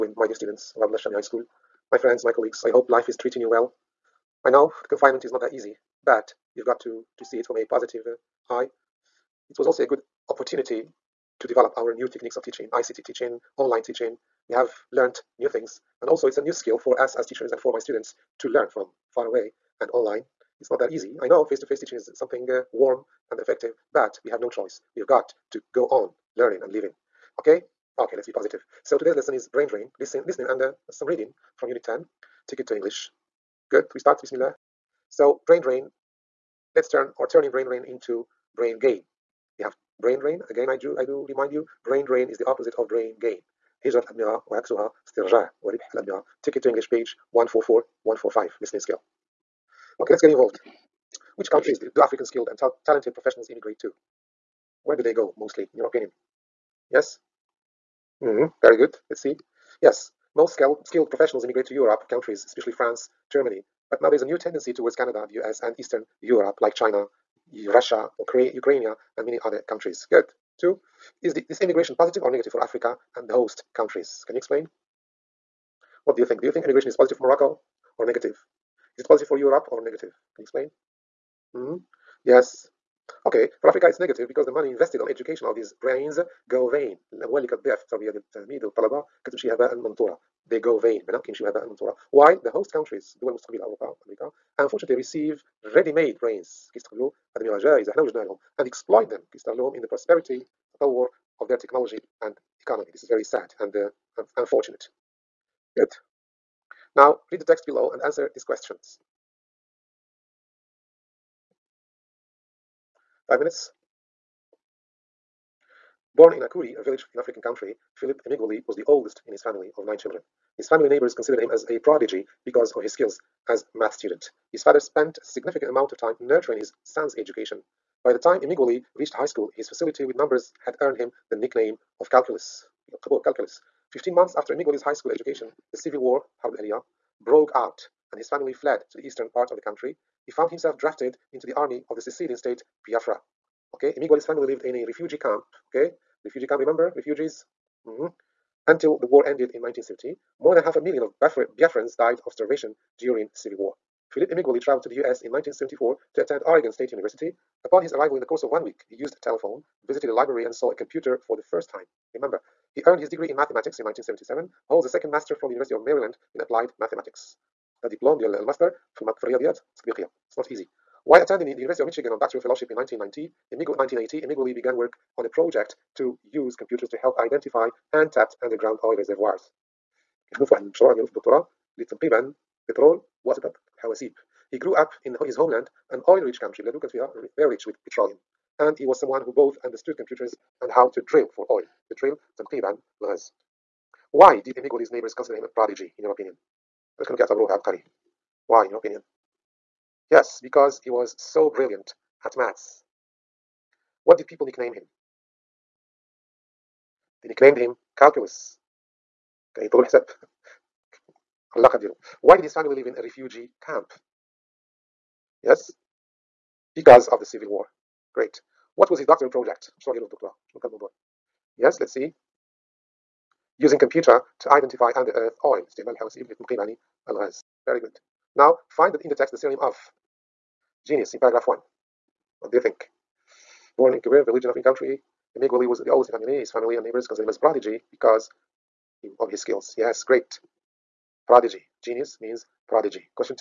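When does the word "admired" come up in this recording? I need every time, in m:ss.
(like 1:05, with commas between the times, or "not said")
not said.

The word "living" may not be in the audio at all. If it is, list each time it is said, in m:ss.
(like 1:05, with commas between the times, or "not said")
0:26.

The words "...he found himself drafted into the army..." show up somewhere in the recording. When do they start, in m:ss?
2:20.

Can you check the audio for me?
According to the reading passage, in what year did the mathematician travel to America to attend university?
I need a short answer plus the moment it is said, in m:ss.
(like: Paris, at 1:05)
1974, at 2:35.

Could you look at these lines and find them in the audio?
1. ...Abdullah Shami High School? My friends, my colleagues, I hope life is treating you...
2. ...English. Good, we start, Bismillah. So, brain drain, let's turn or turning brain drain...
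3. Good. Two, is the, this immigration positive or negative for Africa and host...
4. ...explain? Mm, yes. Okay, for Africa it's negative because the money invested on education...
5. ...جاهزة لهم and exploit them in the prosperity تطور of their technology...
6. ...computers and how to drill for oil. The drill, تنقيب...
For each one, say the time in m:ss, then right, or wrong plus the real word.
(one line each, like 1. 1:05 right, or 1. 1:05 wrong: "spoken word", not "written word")
1. 0:00 right
2. 0:32 right
3. 1:10 right
4. 1:20 right
5. 1:37 right
6. 3:09 right.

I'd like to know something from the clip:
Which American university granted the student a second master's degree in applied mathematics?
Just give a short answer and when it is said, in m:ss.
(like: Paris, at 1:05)
University of Maryland, at 2:45.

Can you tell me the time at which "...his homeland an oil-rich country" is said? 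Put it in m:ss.
3:05.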